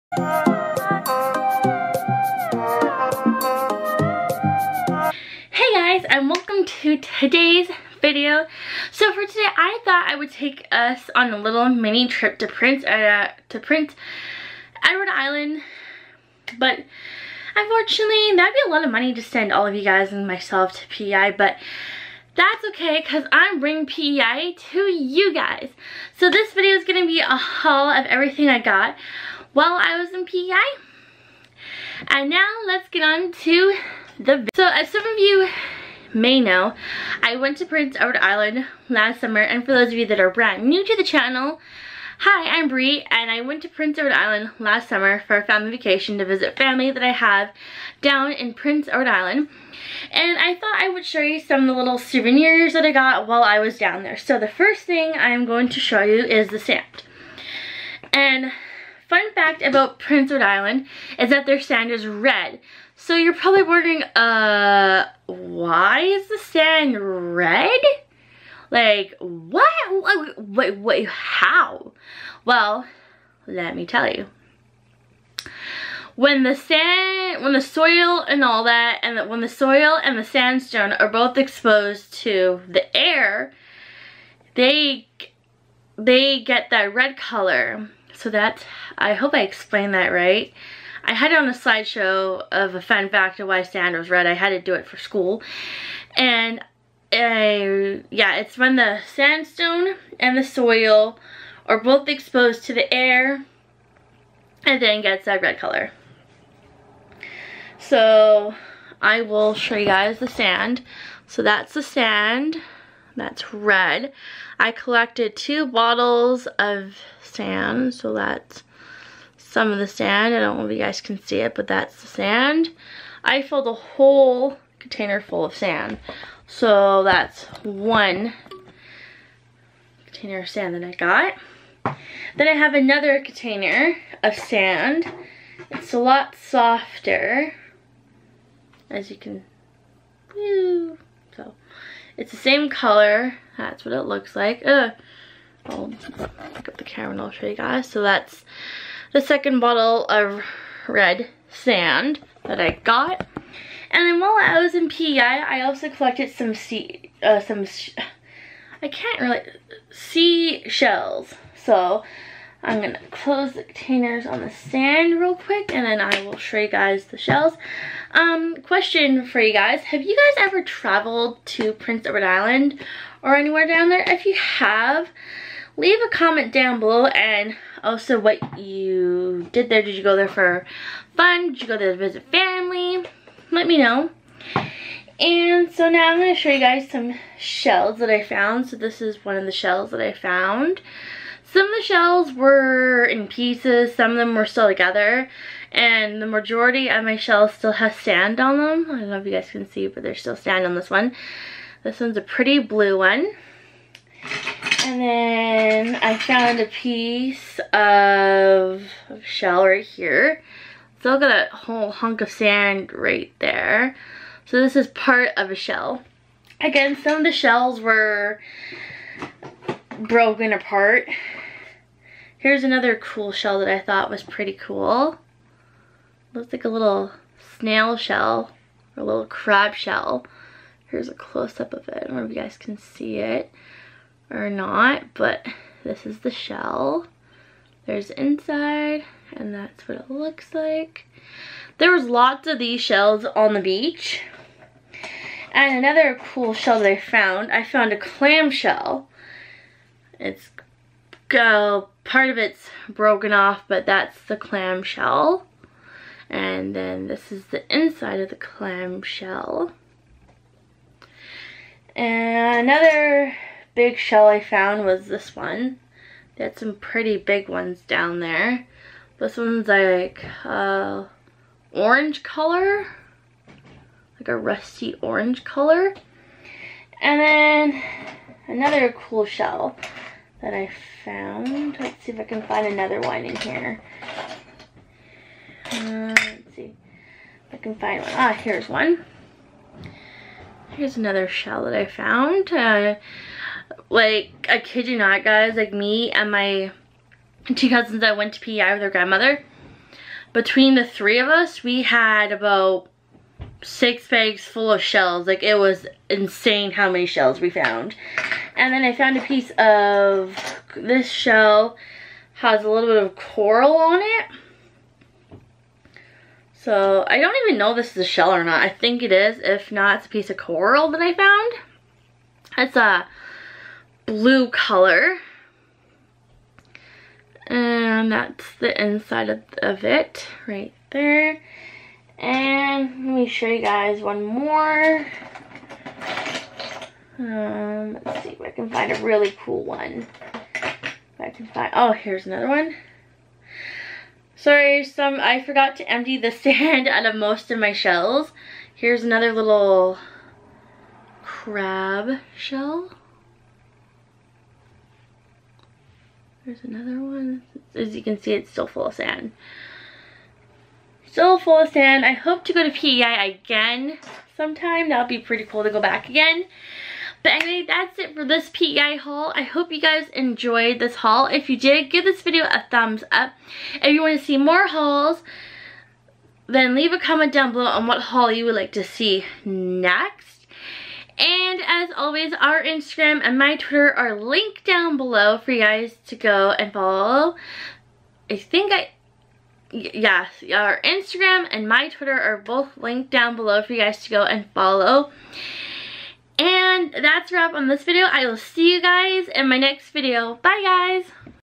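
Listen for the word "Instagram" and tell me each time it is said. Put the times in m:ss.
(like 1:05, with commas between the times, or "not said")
6:22, 6:30.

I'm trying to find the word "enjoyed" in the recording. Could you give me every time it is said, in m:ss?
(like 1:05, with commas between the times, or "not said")
6:10.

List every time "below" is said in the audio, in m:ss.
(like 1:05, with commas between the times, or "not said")
2:56, 6:17, 6:24, 6:33.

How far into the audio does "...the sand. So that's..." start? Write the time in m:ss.
1:50.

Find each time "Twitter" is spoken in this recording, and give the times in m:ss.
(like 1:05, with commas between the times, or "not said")
6:23, 6:31.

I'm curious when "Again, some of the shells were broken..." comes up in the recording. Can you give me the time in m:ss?
3:36.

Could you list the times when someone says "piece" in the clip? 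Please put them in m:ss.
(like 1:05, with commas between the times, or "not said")
3:13, 3:26, 5:09, 5:20.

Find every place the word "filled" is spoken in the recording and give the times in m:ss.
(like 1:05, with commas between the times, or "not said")
2:03.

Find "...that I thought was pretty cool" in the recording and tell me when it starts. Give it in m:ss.
3:43.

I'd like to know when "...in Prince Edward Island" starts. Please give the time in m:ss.
0:48.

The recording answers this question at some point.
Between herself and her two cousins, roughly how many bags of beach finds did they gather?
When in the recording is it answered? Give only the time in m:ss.
5:03.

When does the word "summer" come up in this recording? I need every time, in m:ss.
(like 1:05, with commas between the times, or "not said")
0:39, 0:44.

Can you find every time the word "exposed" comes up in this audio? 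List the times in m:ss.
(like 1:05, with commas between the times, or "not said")
1:21, 1:42.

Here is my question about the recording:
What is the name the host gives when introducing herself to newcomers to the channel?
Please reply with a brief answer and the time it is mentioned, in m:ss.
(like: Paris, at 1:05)
Bri, at 0:42.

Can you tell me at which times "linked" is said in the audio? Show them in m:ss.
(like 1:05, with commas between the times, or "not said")
6:24, 6:32.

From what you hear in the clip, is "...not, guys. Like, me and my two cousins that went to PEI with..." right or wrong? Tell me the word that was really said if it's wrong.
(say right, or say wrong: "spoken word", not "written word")
right.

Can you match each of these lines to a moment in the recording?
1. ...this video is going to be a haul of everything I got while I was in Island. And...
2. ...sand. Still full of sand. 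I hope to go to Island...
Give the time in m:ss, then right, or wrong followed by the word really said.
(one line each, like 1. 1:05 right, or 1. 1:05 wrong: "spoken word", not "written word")
1. 0:26 wrong: "PEI", not "Island"
2. 5:58 wrong: "PEI", not "Island".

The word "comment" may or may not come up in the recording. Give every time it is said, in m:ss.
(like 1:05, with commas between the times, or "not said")
2:56, 6:16.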